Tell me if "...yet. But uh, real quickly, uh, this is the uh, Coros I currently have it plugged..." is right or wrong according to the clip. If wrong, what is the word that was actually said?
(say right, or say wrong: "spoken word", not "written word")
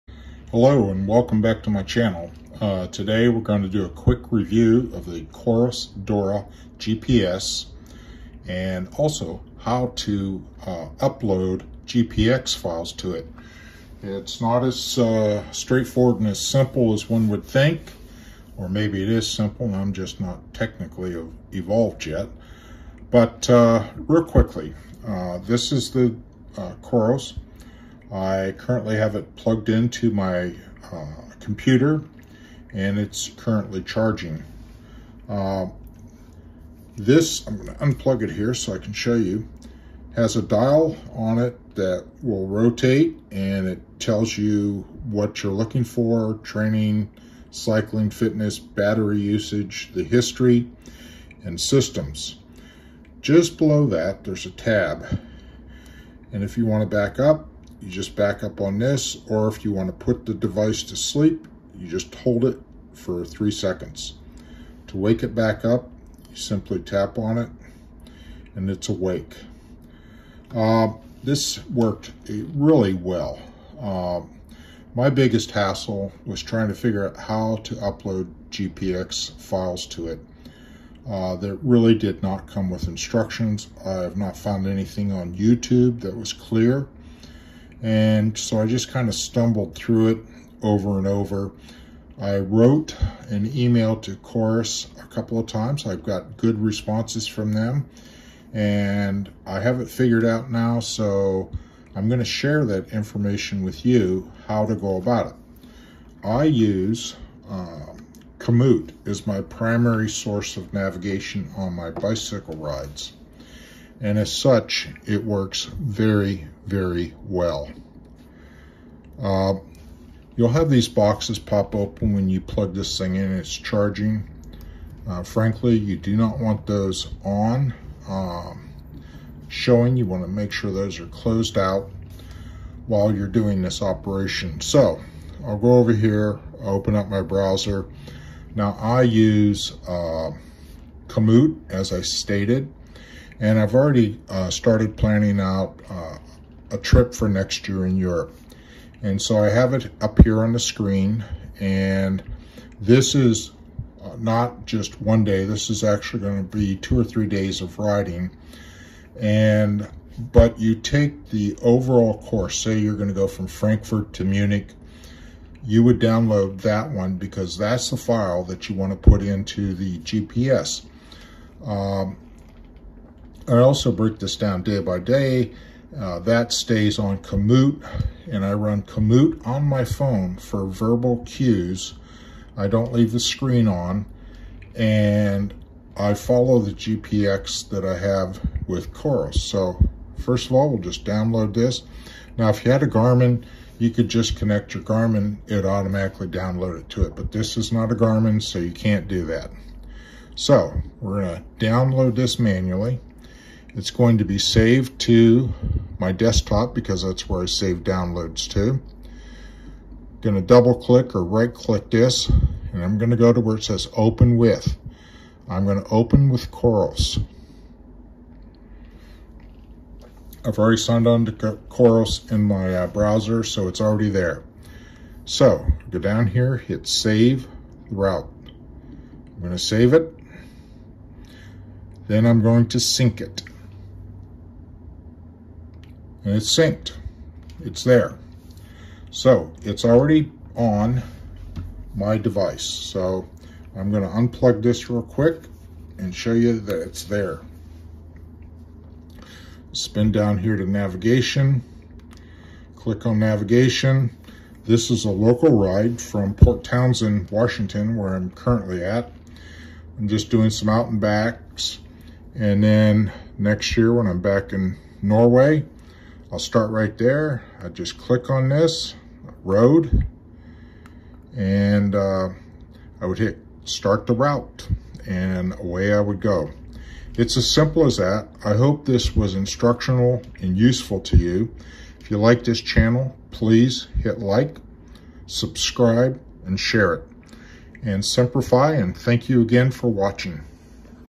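right.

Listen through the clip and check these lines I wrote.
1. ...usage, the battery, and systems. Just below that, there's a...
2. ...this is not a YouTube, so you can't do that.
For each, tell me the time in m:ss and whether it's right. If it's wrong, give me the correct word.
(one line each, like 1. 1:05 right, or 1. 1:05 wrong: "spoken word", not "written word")
1. 0:49 wrong: "history", not "battery"
2. 3:17 wrong: "Garmin", not "YouTube".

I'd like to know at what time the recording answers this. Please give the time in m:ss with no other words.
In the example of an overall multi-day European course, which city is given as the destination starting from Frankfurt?
2:44.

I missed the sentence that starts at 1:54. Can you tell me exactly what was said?
And as such, it works very, very well.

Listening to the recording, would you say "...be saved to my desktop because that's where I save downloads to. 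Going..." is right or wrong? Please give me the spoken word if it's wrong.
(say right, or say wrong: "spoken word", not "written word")
right.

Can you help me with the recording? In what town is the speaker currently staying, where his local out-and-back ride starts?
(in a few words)
Port Townsend.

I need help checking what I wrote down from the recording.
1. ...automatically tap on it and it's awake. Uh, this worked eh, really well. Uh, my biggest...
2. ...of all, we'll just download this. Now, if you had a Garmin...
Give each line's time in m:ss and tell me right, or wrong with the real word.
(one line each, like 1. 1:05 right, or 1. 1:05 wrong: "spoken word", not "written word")
1. 1:06 wrong: "simply", not "automatically"
2. 3:10 right.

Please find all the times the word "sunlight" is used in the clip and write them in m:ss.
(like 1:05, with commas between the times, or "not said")
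not said.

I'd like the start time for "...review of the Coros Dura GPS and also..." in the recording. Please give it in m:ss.
0:04.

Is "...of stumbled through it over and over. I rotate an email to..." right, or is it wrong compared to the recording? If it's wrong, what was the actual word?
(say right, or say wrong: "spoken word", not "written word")
wrong: "wrote", not "rotate".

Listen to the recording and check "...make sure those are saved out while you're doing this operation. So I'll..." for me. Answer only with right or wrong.
wrong.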